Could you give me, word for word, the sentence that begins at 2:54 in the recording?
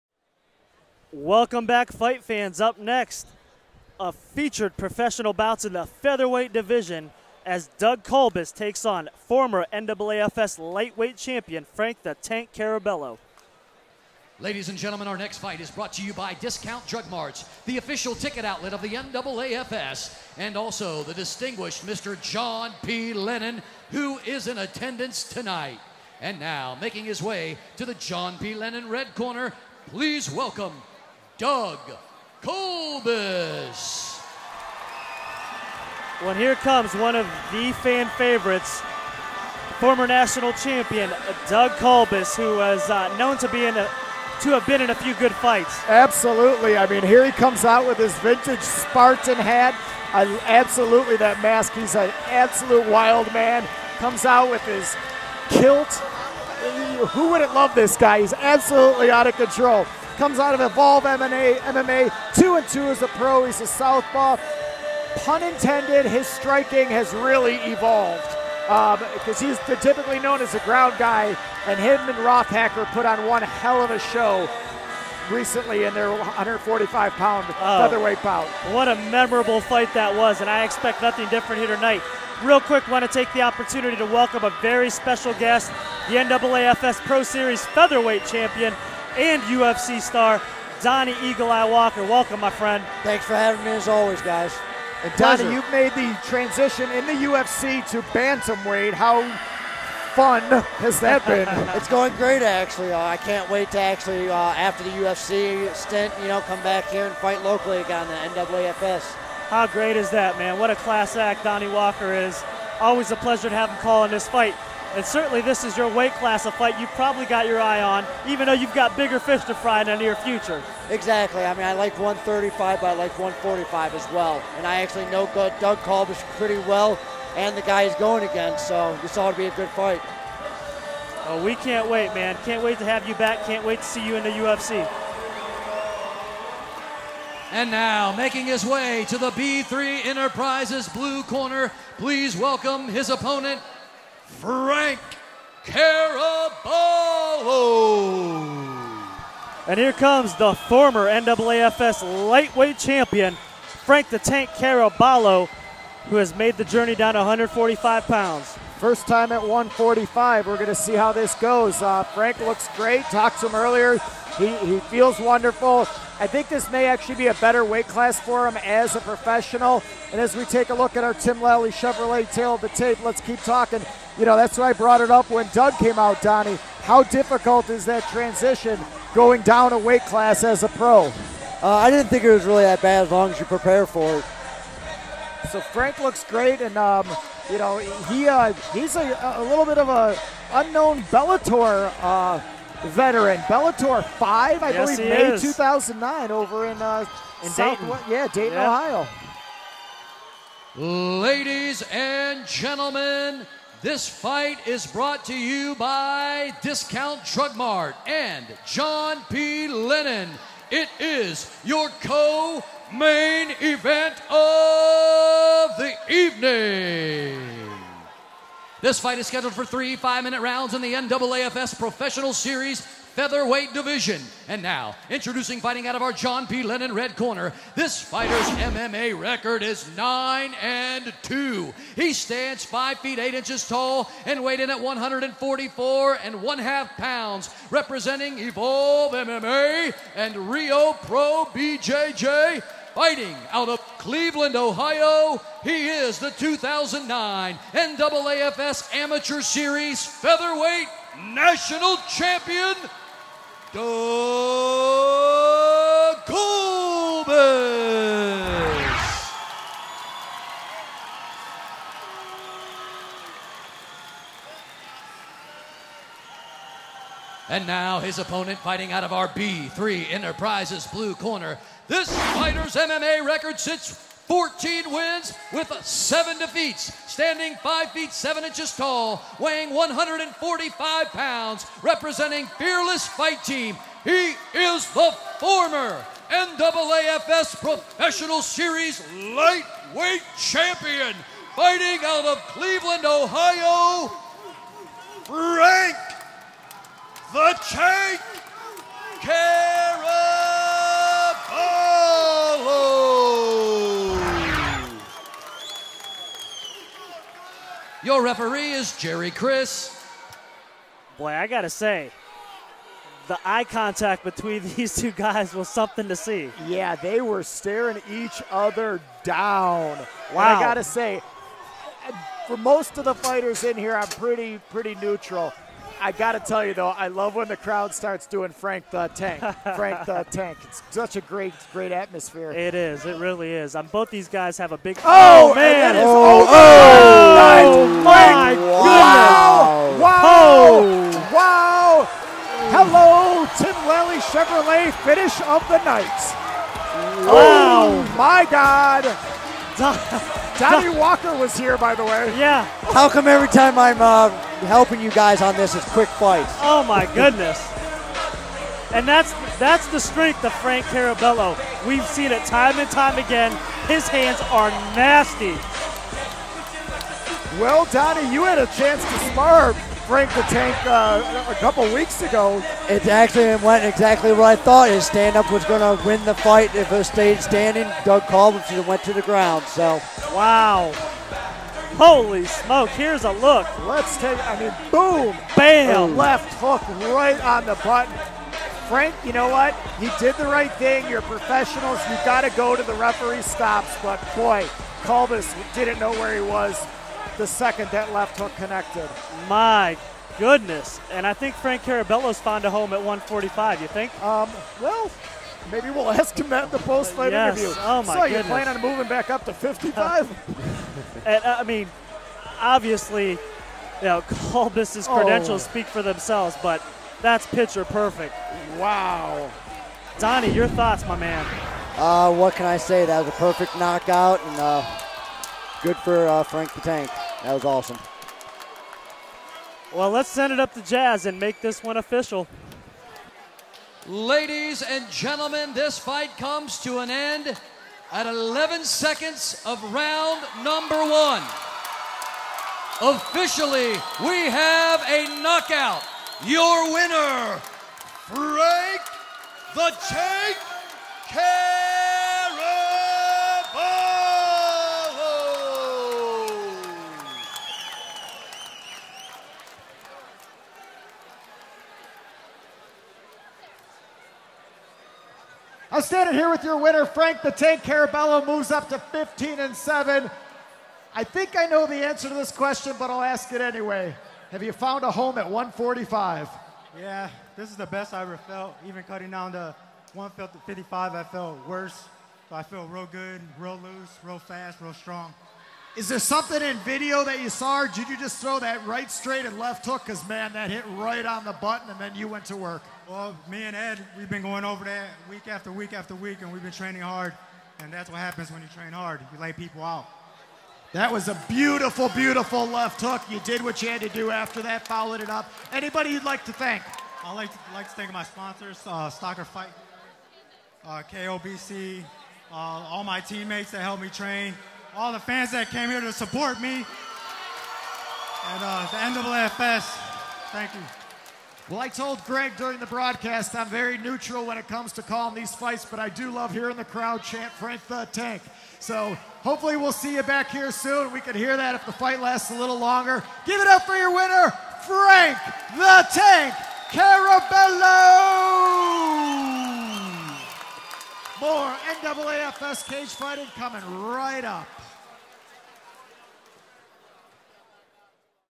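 You know, that's why I brought it up when Doug came out, Donnie.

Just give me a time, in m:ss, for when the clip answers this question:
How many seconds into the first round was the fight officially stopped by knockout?
7:18.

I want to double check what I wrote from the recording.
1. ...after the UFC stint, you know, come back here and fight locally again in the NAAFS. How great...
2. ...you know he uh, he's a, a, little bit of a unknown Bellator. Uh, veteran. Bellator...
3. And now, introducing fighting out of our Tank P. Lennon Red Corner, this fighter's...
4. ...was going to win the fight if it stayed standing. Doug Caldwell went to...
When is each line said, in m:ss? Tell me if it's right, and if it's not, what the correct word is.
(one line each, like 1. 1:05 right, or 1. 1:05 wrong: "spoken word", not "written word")
1. 1:44 right
2. 3:07 right
3. 3:44 wrong: "John", not "Tank"
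4. 6:15 right.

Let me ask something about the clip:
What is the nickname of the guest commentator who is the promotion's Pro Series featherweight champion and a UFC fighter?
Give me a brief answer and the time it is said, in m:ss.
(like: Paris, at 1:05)
Eagle Eye, at 1:31.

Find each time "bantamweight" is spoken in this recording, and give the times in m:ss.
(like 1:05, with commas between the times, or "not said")
1:38.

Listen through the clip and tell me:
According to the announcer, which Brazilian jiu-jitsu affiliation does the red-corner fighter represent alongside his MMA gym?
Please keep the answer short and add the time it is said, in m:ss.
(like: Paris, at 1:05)
Rio Pro BJJ, at 4:00.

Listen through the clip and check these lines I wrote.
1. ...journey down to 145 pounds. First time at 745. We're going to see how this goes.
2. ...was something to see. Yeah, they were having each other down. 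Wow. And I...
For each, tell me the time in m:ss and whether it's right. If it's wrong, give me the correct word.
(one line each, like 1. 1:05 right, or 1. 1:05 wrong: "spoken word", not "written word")
1. 2:36 wrong: "145", not "745"
2. 5:15 wrong: "staring", not "having".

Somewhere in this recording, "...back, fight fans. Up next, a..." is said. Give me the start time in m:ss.
0:01.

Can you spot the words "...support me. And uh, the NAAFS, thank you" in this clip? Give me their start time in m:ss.
8:36.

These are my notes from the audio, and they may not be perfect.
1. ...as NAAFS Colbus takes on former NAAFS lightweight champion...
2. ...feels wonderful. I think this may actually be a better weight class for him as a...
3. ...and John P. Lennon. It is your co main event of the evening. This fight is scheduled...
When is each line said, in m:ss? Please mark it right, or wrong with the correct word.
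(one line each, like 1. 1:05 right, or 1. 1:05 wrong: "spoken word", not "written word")
1. 0:07 wrong: "Doug", not "NAAFS"
2. 2:44 right
3. 3:28 right.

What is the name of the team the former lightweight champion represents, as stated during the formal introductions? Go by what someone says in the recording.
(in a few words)
Fearless Fight Team.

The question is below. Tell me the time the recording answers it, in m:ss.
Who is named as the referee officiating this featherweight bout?
5:08.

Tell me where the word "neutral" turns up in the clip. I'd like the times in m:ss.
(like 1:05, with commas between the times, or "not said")
5:24, 8:43.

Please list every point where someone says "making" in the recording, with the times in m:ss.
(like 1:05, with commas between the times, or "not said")
0:26, 2:18.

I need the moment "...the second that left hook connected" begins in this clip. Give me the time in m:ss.
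6:37.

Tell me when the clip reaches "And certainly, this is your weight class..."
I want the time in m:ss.
1:54.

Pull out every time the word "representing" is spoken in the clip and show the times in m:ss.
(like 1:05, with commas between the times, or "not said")
3:57, 4:41.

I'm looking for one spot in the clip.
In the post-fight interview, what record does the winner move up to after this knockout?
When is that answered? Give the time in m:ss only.
7:48.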